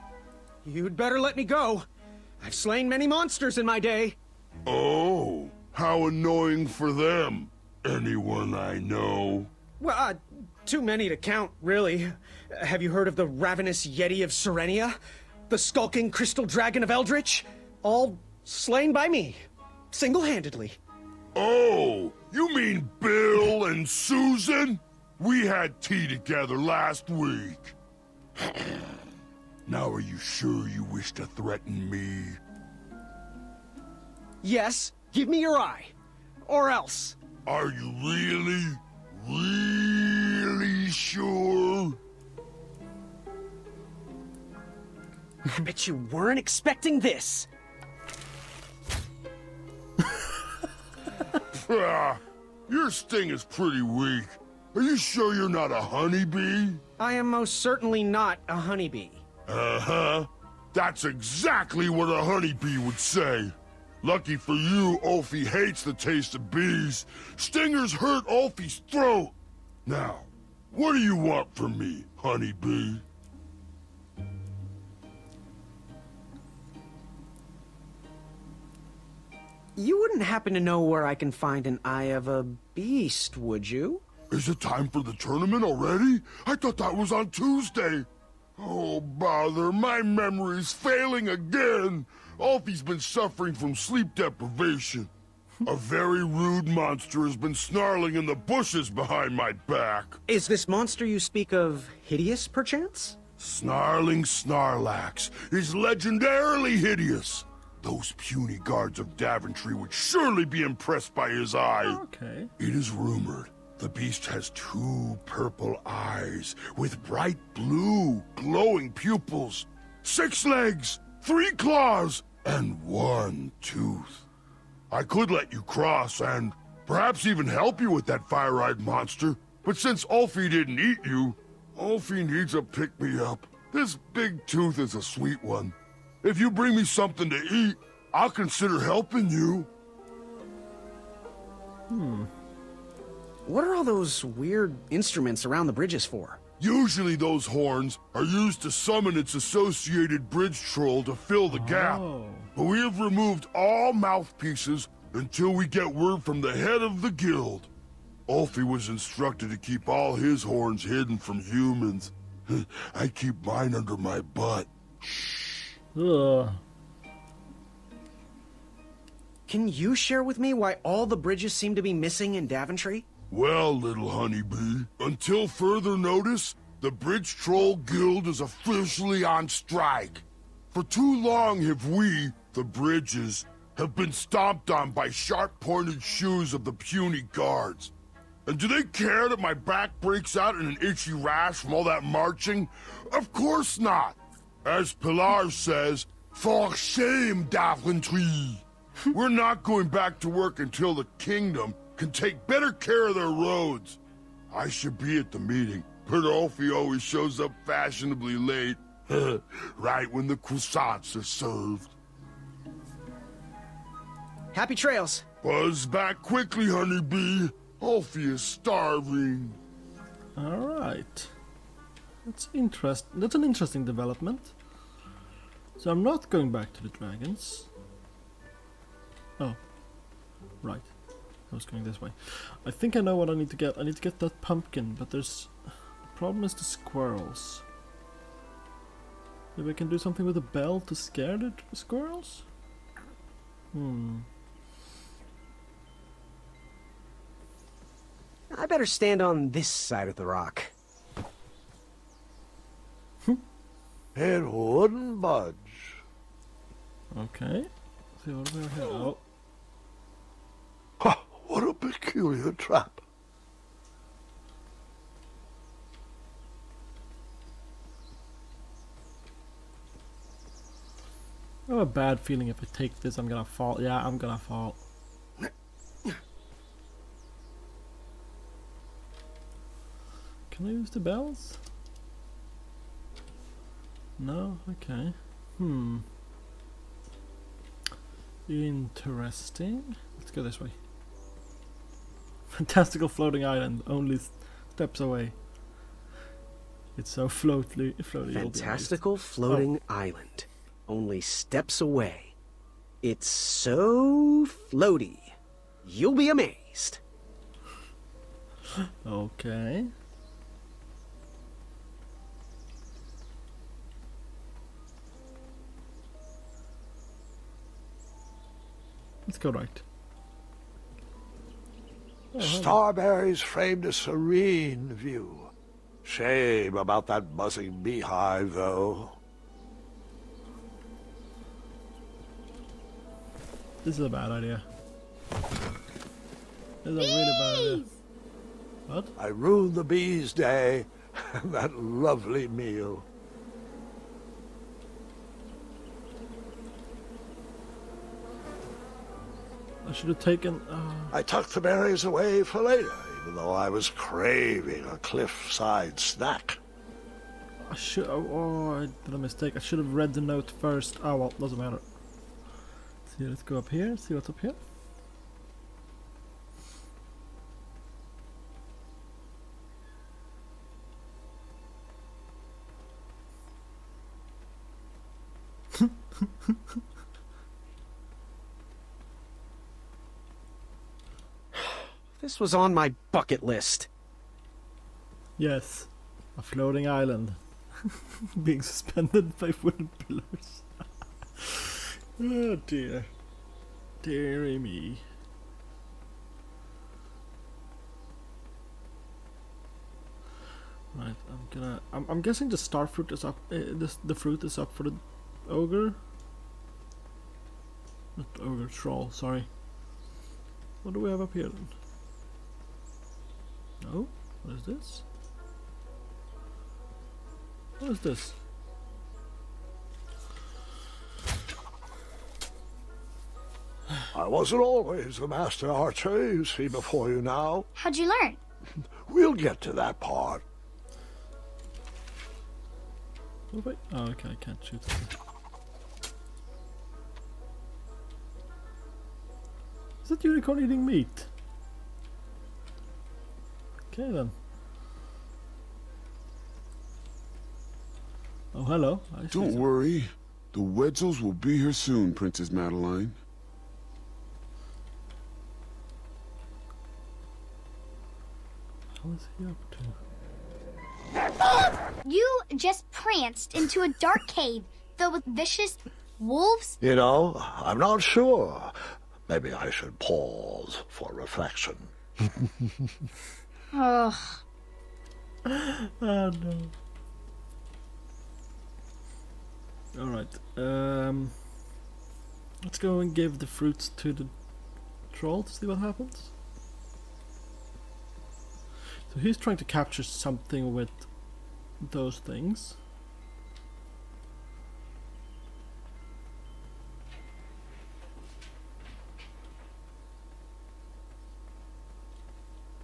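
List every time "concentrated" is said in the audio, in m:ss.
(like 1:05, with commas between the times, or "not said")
not said.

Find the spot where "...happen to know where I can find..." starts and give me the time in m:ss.
1:20.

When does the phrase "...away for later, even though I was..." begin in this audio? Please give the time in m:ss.
5:52.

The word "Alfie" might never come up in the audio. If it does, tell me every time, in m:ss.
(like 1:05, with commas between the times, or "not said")
1:32, 3:37.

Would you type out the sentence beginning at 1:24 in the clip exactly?
Is it time for the tournament already?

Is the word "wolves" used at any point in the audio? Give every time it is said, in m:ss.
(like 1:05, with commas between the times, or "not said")
7:46.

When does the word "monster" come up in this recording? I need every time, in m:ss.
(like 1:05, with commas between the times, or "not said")
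0:03, 1:36, 1:40, 2:08.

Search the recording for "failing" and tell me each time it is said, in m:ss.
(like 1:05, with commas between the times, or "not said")
1:30.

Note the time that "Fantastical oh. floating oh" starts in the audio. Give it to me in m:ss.
4:58.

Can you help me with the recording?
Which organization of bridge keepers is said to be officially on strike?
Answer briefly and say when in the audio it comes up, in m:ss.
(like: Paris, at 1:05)
Bridge Troll Guild, at 2:56.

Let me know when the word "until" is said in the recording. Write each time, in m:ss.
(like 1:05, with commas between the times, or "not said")
2:35, 2:54, 3:20.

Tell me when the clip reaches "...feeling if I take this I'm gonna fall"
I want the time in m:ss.
4:32.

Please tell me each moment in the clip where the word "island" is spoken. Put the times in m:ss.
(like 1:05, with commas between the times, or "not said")
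4:53, 4:59, 6:26.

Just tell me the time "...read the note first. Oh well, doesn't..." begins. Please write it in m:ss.
5:59.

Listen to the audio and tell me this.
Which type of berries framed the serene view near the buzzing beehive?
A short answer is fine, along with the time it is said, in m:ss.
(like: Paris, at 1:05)
Starberries, at 5:22.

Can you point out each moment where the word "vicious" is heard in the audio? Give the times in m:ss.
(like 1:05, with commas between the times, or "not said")
7:45.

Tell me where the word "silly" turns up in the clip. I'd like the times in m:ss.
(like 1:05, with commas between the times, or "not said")
not said.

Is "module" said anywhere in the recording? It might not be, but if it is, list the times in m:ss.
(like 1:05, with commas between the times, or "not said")
not said.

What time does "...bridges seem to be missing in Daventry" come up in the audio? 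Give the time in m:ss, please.
2:51.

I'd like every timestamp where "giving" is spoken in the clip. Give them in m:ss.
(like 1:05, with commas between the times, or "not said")
not said.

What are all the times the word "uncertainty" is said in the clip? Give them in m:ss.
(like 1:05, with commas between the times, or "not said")
not said.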